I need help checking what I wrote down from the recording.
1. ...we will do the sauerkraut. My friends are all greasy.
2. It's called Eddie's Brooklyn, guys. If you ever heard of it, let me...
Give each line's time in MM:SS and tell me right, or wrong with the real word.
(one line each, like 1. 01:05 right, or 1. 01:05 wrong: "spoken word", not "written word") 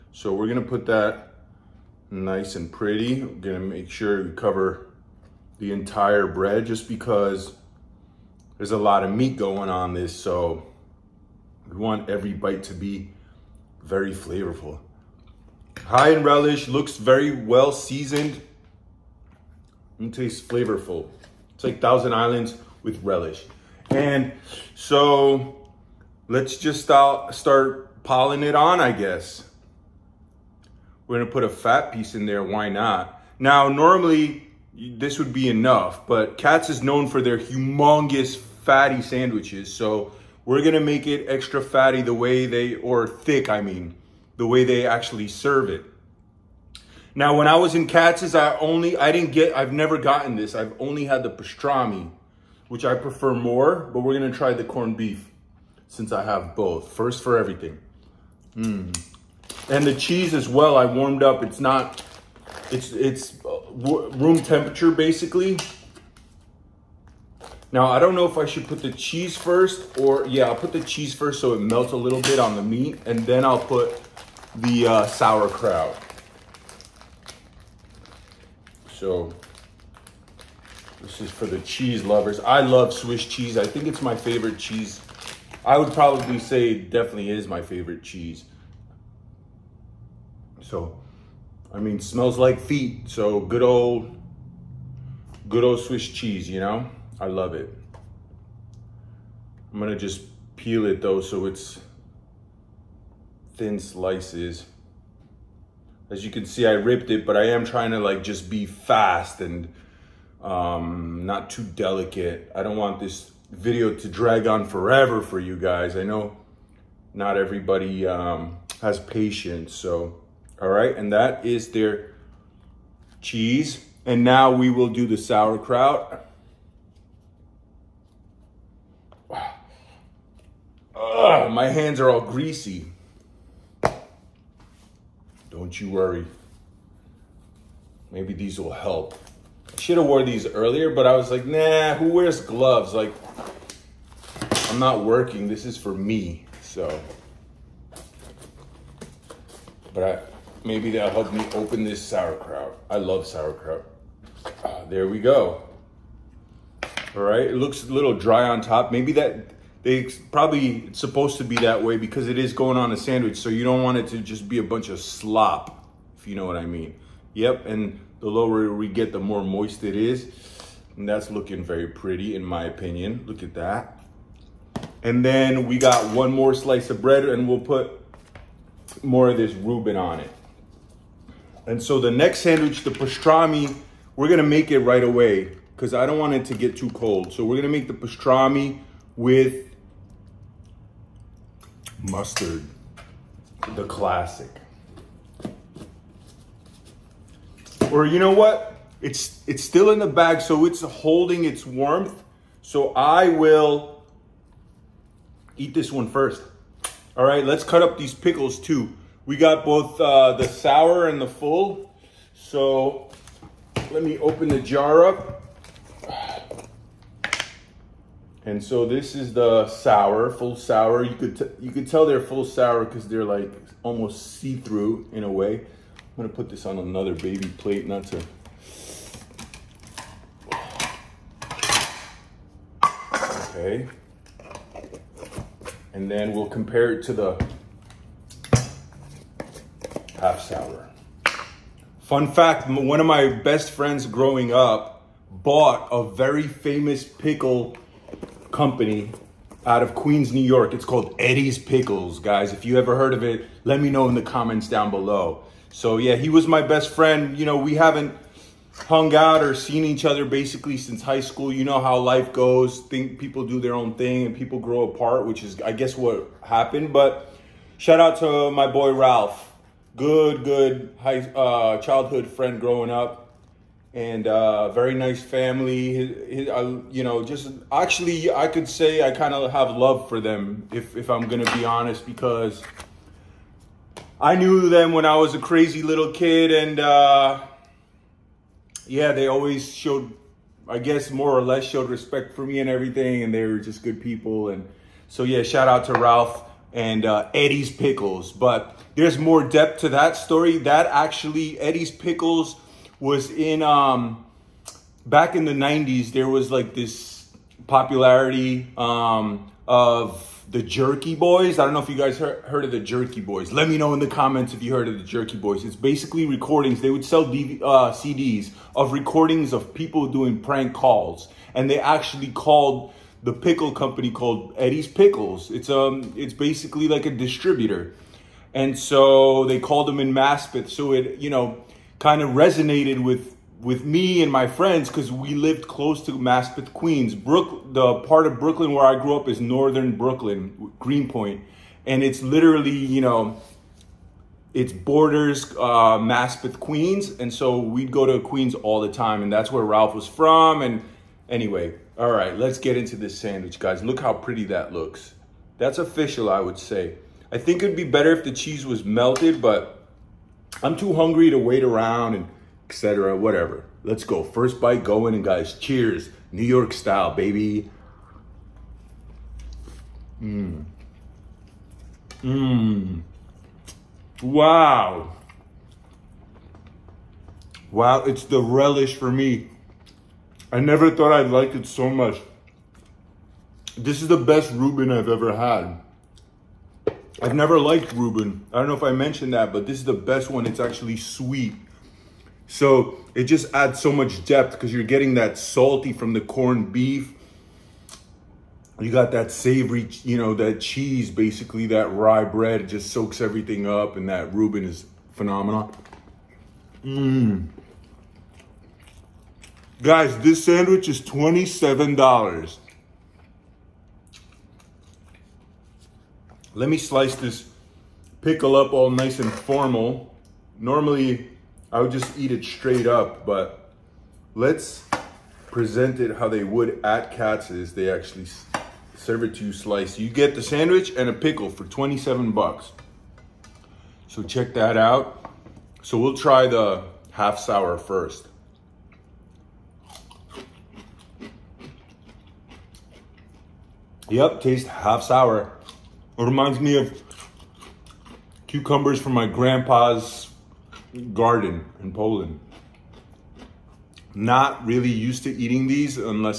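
1. 02:04 wrong: "hands", not "friends"
2. 04:10 wrong: "Pickles", not "Brooklyn".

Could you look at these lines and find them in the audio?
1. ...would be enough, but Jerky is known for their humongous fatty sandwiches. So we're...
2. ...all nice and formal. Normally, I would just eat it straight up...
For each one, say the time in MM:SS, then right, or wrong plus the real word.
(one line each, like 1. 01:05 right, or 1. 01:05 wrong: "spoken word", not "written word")
1. 00:35 wrong: "Katz", not "Jerky"
2. 06:58 right.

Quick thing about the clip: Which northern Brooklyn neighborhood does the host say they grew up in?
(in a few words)
Greenpoint.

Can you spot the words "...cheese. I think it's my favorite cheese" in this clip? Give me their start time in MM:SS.
01:23.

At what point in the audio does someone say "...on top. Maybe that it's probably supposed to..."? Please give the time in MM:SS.
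02:38.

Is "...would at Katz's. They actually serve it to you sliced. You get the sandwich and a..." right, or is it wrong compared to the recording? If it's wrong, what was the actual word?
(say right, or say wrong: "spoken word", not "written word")
right.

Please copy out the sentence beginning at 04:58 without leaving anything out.
But there's more depth to that story.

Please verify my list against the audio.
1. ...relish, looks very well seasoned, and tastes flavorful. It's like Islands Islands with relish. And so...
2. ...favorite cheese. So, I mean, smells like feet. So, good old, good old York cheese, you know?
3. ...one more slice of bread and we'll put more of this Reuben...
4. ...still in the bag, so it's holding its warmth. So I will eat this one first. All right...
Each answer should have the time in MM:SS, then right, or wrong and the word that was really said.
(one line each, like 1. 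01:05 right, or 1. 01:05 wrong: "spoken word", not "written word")
1. 00:16 wrong: "Thousand", not "Islands"
2. 01:27 wrong: "Swiss", not "York"
3. 02:56 right
4. 03:19 right.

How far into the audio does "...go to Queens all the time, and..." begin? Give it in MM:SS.
05:47.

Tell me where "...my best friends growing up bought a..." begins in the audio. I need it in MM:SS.
04:03.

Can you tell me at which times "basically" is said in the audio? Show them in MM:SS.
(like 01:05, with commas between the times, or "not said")
01:04, 04:20, 05:15, 05:26, 06:41.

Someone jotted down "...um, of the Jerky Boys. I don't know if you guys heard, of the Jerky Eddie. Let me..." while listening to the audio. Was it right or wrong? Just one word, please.
wrong.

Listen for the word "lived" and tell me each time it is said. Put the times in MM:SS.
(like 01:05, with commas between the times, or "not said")
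05:35.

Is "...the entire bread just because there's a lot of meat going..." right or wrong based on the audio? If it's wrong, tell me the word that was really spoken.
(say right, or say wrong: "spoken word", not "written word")
right.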